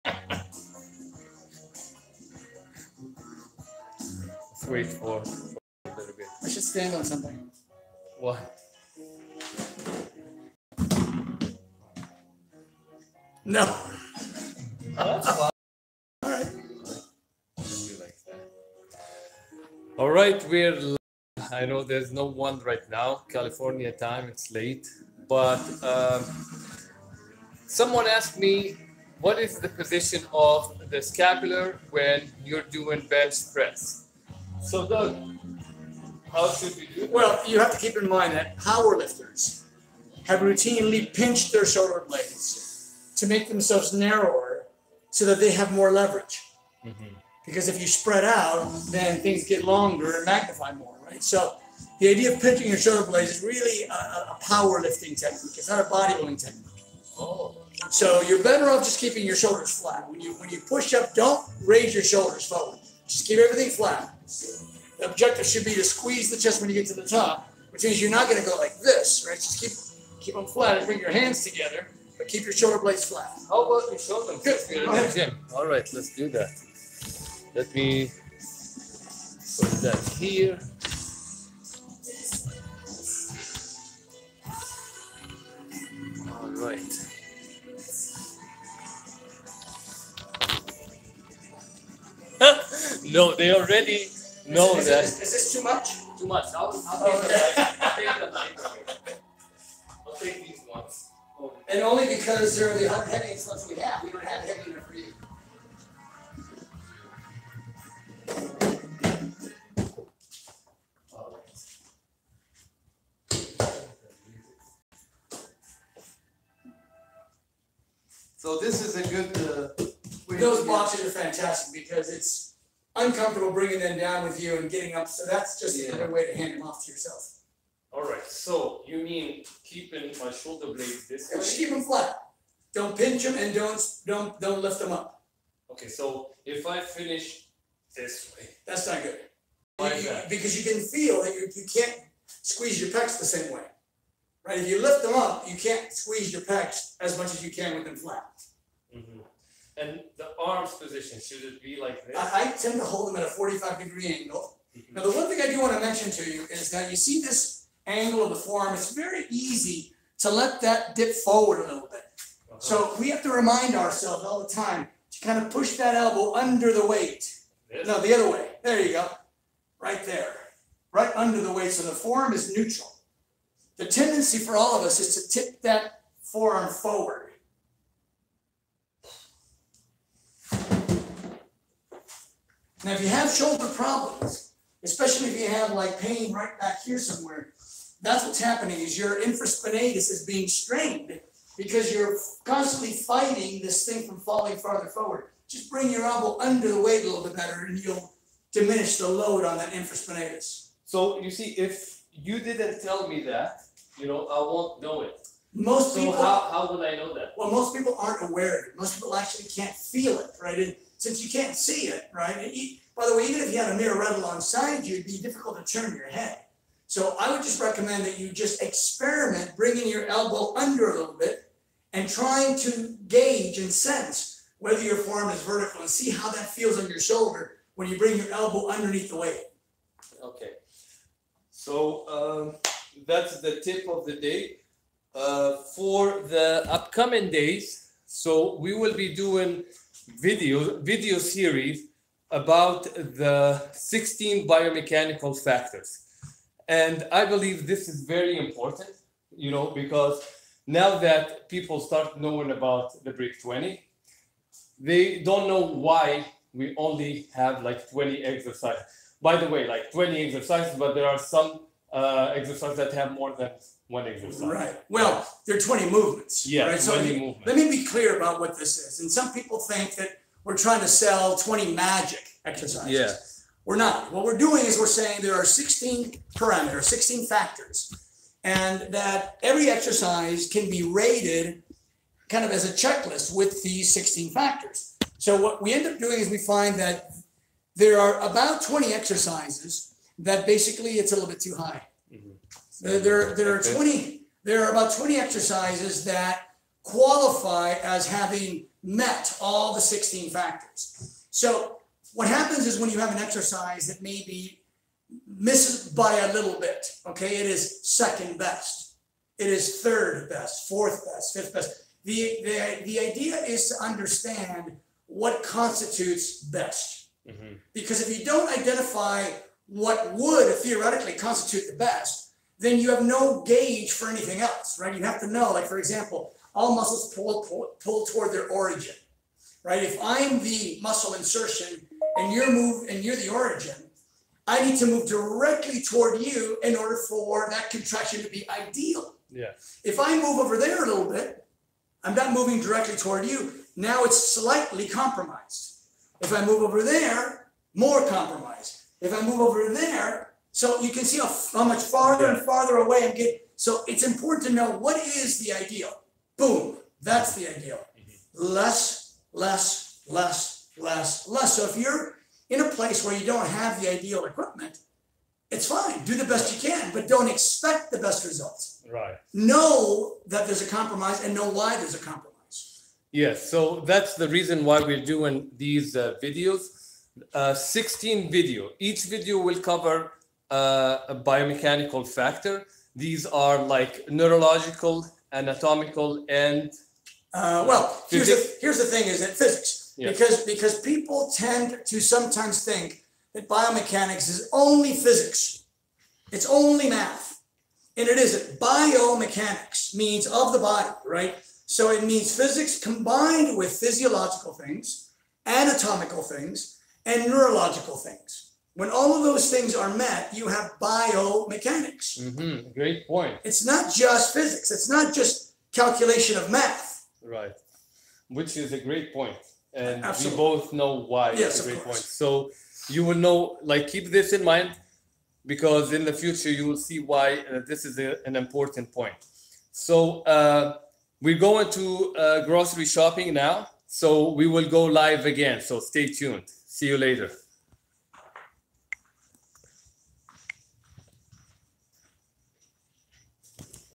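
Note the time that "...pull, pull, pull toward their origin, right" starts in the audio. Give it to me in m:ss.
5:27.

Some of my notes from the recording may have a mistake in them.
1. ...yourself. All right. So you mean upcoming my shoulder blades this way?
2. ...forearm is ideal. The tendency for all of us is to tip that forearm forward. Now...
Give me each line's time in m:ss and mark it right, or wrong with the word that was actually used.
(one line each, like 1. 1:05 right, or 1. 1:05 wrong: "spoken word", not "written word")
1. 2:06 wrong: "keeping", not "upcoming"
2. 2:51 wrong: "neutral", not "ideal".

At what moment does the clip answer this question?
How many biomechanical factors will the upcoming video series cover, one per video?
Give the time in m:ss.
4:03.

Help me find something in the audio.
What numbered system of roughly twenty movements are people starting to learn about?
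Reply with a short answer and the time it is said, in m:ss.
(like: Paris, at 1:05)
BRIG 20, at 4:13.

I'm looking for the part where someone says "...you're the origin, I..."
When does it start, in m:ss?
5:33.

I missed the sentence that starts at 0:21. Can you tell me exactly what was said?
I know there's no one right now.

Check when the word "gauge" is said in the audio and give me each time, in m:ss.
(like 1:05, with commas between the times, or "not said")
3:43, 5:23.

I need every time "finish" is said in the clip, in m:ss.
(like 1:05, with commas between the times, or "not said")
2:16.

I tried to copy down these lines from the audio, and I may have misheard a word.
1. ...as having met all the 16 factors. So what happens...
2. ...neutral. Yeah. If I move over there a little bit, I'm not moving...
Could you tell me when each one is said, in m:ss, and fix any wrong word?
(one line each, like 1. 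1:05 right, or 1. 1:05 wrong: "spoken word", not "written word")
1. 4:57 right
2. 5:38 wrong: "ideal", not "neutral".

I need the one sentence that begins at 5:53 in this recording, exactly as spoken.
So it's important to know what is the ideal.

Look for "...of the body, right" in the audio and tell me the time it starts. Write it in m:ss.
6:40.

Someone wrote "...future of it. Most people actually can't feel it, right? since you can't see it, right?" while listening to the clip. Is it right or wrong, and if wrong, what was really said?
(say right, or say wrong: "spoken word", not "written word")
wrong: "aware", not "future".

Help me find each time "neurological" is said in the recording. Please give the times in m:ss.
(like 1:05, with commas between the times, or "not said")
6:24, 6:47.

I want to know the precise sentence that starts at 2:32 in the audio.
I, I tend to hold them at a 45 degree angle.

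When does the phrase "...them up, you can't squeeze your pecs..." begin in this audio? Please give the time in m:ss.
2:25.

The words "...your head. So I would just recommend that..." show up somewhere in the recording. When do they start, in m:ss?
3:35.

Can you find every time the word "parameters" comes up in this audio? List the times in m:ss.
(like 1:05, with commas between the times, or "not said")
4:36.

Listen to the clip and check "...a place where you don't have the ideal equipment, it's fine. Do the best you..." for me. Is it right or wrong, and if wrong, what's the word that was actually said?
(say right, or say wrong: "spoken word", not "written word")
right.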